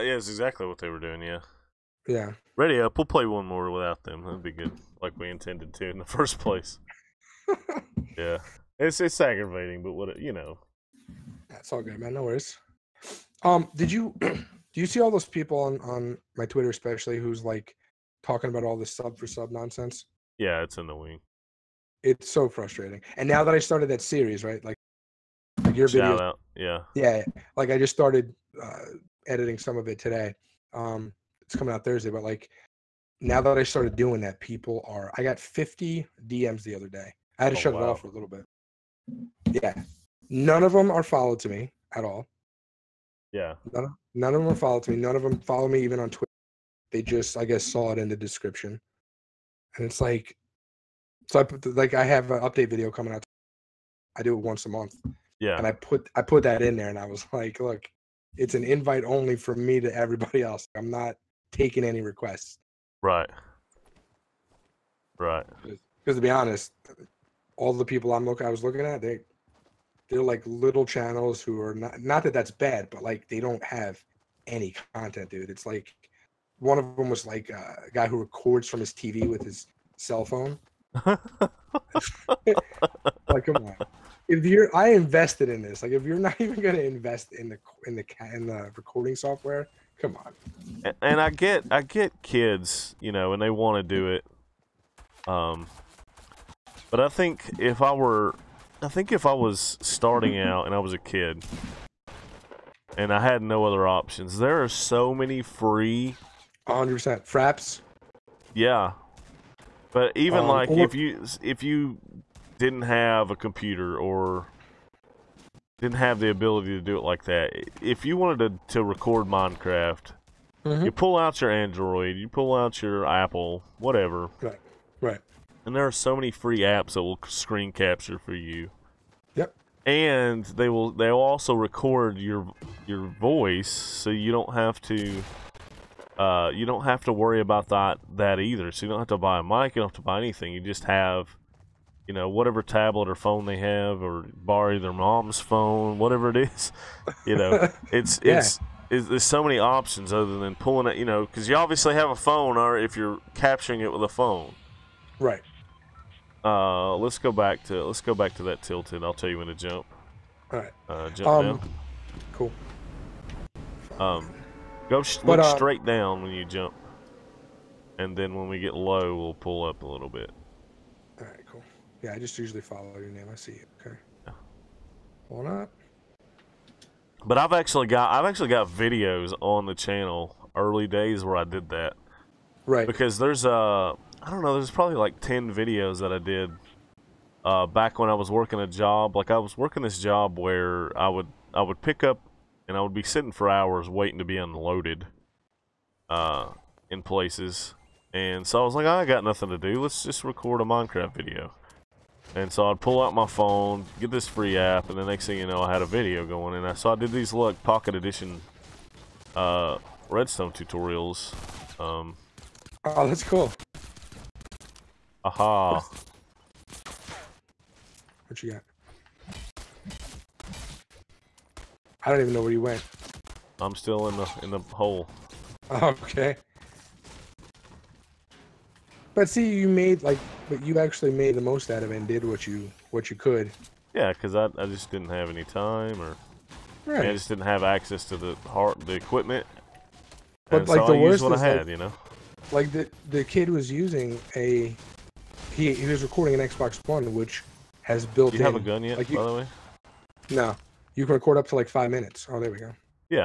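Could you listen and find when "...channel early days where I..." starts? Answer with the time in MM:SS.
02:59.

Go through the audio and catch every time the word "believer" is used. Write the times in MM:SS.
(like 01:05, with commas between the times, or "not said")
not said.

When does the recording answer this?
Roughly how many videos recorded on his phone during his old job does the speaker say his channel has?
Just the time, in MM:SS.
03:05.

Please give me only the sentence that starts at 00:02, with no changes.
We'll play one more without them.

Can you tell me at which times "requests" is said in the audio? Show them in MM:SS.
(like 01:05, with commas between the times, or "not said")
01:02.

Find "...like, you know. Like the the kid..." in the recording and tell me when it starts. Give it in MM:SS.
04:01.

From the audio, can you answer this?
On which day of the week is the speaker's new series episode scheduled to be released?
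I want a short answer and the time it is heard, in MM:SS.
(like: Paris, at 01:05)
Thursday, at 00:31.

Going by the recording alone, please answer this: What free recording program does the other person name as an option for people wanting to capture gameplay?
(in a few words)
Fraps.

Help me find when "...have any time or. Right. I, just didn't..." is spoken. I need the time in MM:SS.
03:55.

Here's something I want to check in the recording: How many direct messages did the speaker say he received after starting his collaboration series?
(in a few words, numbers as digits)
50.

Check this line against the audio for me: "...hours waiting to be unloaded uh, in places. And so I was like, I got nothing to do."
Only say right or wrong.
right.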